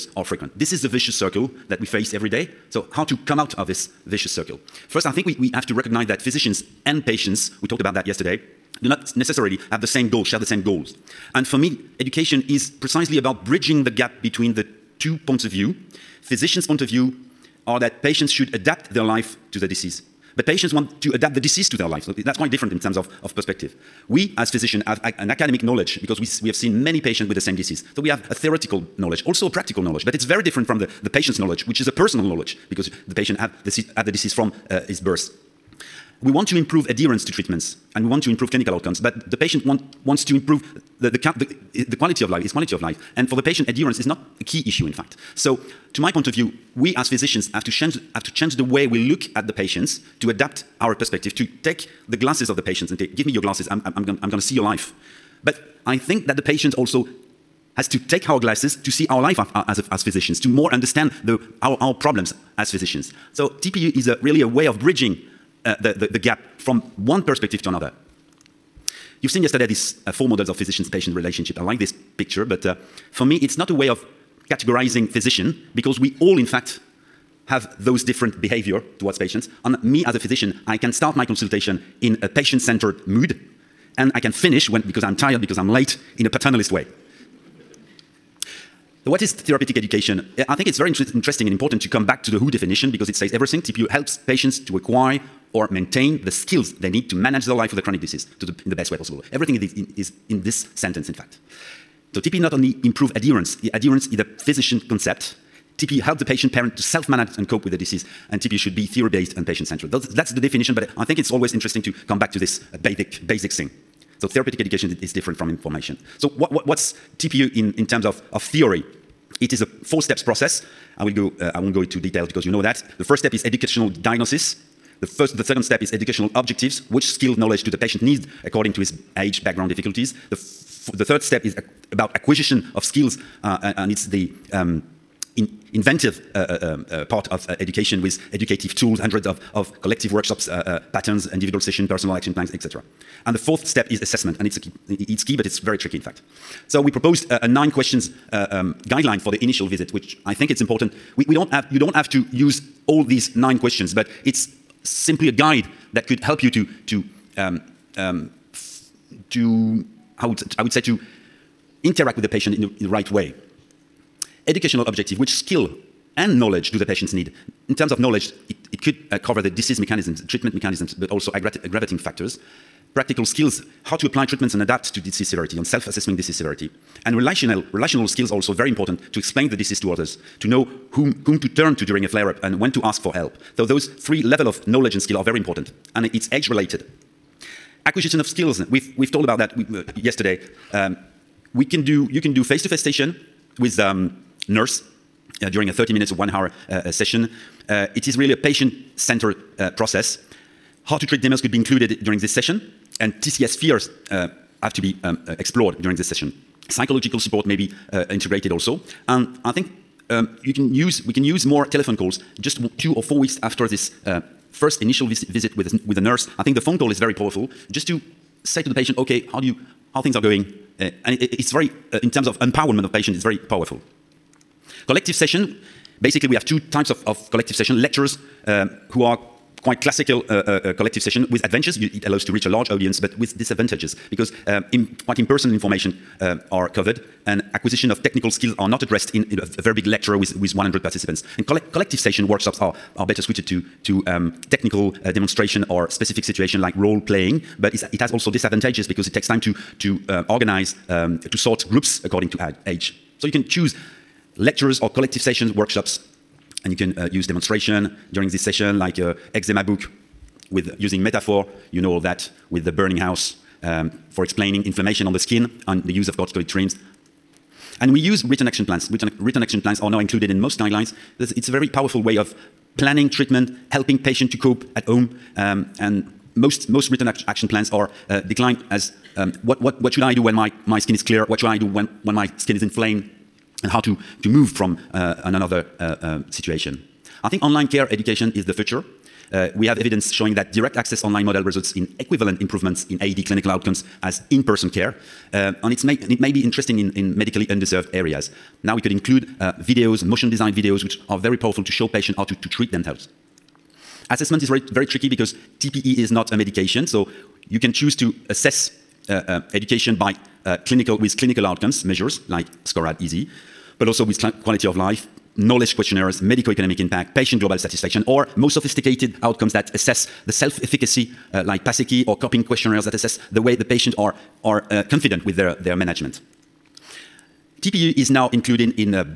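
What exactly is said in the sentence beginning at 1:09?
You've seen yesterday these uh, four models of physician-patient relationship.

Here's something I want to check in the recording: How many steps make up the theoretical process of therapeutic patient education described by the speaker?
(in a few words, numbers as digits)
4.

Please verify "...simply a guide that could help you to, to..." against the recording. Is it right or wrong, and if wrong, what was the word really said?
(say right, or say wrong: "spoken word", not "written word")
right.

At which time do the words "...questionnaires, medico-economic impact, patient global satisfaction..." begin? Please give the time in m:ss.
5:15.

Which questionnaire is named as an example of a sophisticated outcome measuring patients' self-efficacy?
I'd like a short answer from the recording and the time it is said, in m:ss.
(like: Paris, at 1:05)
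PASECI, at 5:21.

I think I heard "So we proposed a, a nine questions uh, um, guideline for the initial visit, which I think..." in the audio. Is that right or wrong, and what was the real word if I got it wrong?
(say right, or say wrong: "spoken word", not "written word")
right.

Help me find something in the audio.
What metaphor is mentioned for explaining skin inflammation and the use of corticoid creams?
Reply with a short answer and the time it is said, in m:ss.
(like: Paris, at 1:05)
The burning house, at 4:22.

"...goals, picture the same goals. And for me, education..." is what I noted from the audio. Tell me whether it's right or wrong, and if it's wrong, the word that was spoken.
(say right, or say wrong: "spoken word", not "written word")
wrong: "share", not "picture".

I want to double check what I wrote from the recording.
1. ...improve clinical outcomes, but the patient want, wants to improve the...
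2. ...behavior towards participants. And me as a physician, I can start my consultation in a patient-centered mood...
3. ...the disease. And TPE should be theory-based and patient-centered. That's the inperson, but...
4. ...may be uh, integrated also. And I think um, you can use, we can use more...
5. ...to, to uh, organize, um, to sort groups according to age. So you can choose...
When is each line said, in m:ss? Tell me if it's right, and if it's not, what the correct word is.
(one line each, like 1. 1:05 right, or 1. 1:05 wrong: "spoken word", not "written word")
1. 0:38 right
2. 1:18 wrong: "patients", not "participants"
3. 1:47 wrong: "definition", not "inperson"
4. 3:27 right
5. 4:09 right.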